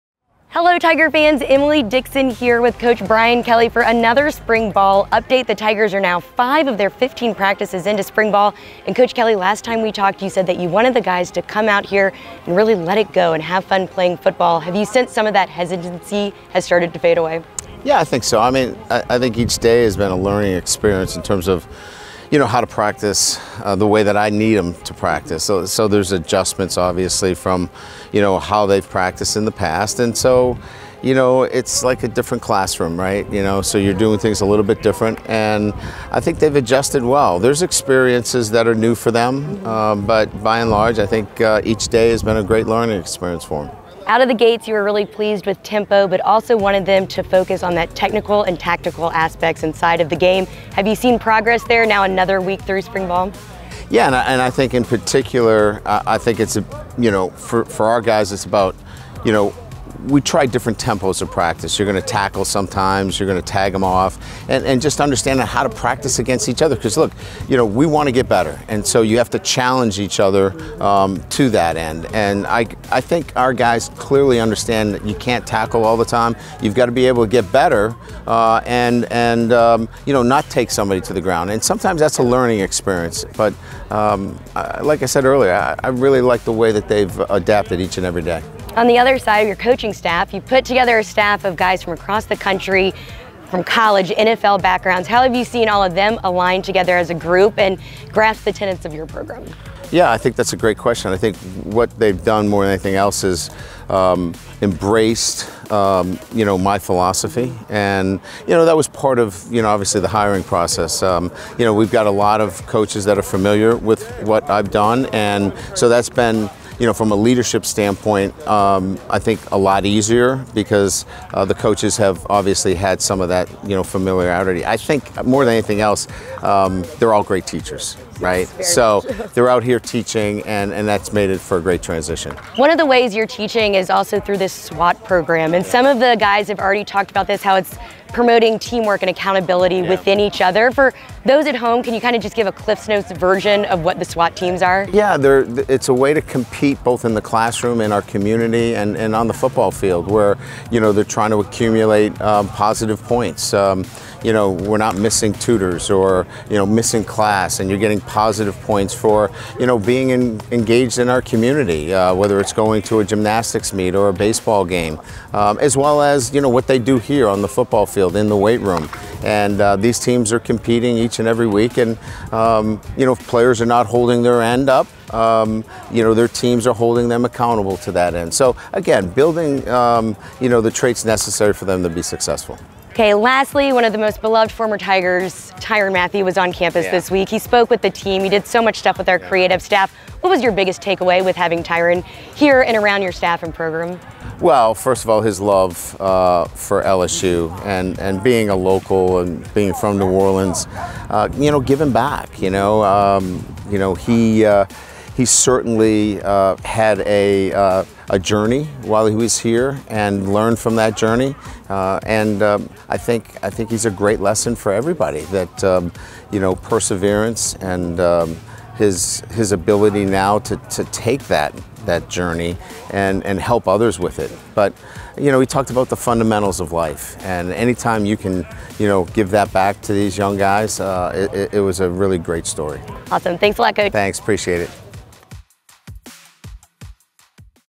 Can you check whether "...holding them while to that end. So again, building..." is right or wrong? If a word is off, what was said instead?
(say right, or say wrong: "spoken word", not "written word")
wrong: "accountable", not "while".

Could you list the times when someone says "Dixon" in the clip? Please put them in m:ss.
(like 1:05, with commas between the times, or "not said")
0:01.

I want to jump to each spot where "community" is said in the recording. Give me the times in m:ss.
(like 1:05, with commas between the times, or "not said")
2:28, 2:41.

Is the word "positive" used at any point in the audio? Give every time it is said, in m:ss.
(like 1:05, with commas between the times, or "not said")
2:32, 2:38.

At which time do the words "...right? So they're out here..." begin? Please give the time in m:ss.
2:08.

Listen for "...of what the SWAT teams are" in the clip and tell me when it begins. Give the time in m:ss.
2:23.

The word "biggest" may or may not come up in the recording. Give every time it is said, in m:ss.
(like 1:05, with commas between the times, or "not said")
3:10.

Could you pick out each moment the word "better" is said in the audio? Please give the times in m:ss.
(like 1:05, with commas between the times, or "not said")
1:08, 1:17.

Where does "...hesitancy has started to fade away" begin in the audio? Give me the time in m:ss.
0:15.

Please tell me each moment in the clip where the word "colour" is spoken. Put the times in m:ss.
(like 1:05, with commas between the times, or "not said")
not said.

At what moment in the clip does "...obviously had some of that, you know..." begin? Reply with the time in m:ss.
2:02.